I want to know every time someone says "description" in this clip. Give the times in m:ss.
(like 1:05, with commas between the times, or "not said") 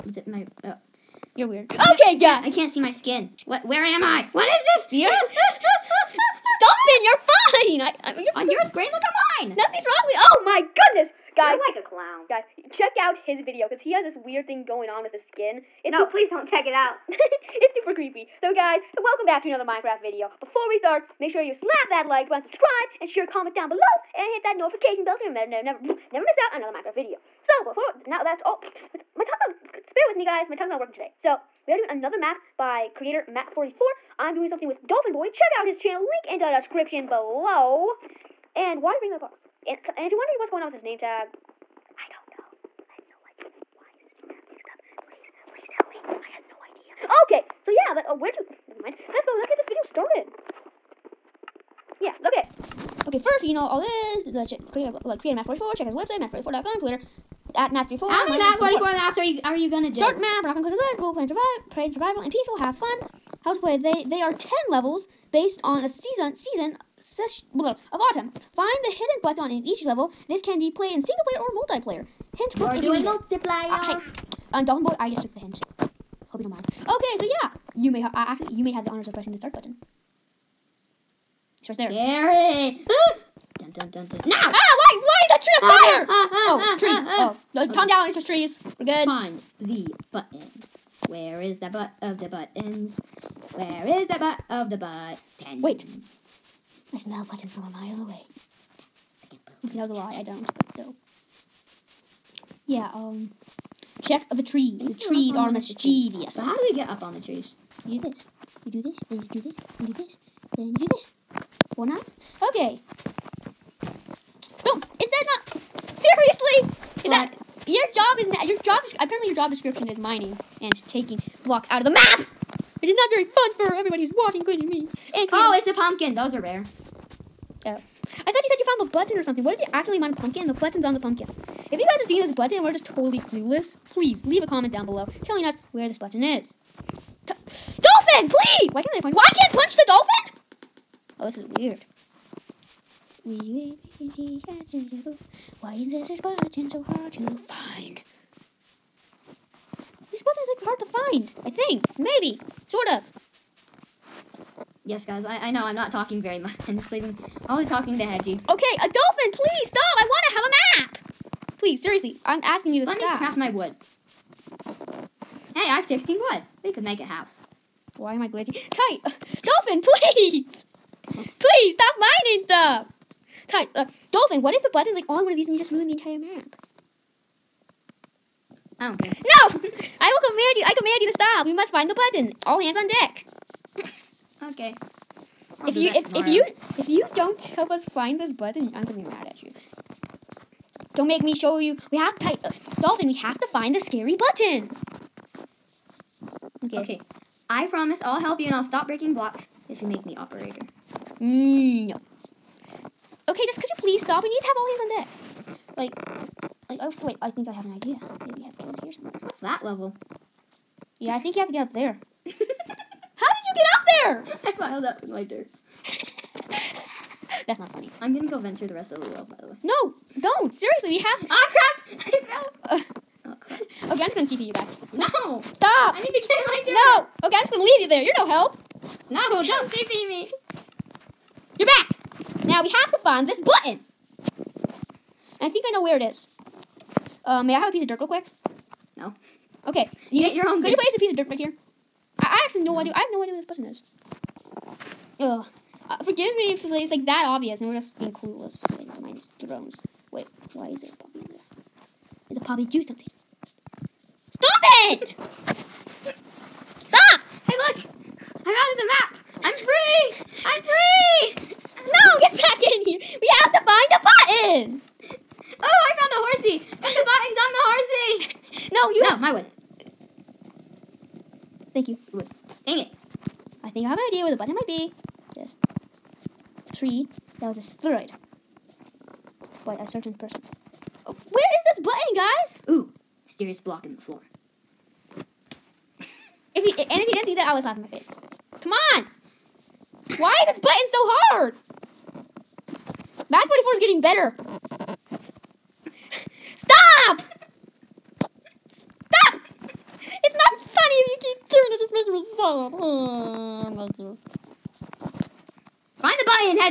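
0:36, 1:59.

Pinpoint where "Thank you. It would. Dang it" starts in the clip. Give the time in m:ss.
4:31.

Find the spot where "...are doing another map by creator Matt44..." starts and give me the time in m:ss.
0:31.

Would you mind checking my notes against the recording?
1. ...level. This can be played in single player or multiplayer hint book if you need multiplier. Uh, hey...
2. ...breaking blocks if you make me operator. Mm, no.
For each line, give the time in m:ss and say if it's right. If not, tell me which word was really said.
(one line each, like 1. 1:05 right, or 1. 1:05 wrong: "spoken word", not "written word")
1. 1:09 right
2. 3:18 right.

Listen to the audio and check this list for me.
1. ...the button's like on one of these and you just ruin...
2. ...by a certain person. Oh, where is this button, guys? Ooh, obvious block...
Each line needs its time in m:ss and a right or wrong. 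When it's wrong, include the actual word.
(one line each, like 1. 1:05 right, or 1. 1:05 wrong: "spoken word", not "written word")
1. 2:54 right
2. 4:39 wrong: "mysterious", not "obvious".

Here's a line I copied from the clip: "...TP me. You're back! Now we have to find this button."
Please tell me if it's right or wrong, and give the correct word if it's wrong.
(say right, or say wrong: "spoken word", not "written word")
right.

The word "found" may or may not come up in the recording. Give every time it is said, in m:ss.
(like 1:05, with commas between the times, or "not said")
2:08, 4:25.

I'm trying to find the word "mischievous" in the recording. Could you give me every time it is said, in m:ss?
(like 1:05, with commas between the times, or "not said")
1:45.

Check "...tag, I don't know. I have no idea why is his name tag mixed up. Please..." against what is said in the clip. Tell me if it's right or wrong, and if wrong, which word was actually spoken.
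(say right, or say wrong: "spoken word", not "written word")
right.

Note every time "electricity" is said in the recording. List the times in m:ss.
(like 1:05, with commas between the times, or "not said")
not said.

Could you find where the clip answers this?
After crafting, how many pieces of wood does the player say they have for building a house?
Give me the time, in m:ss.
2:45.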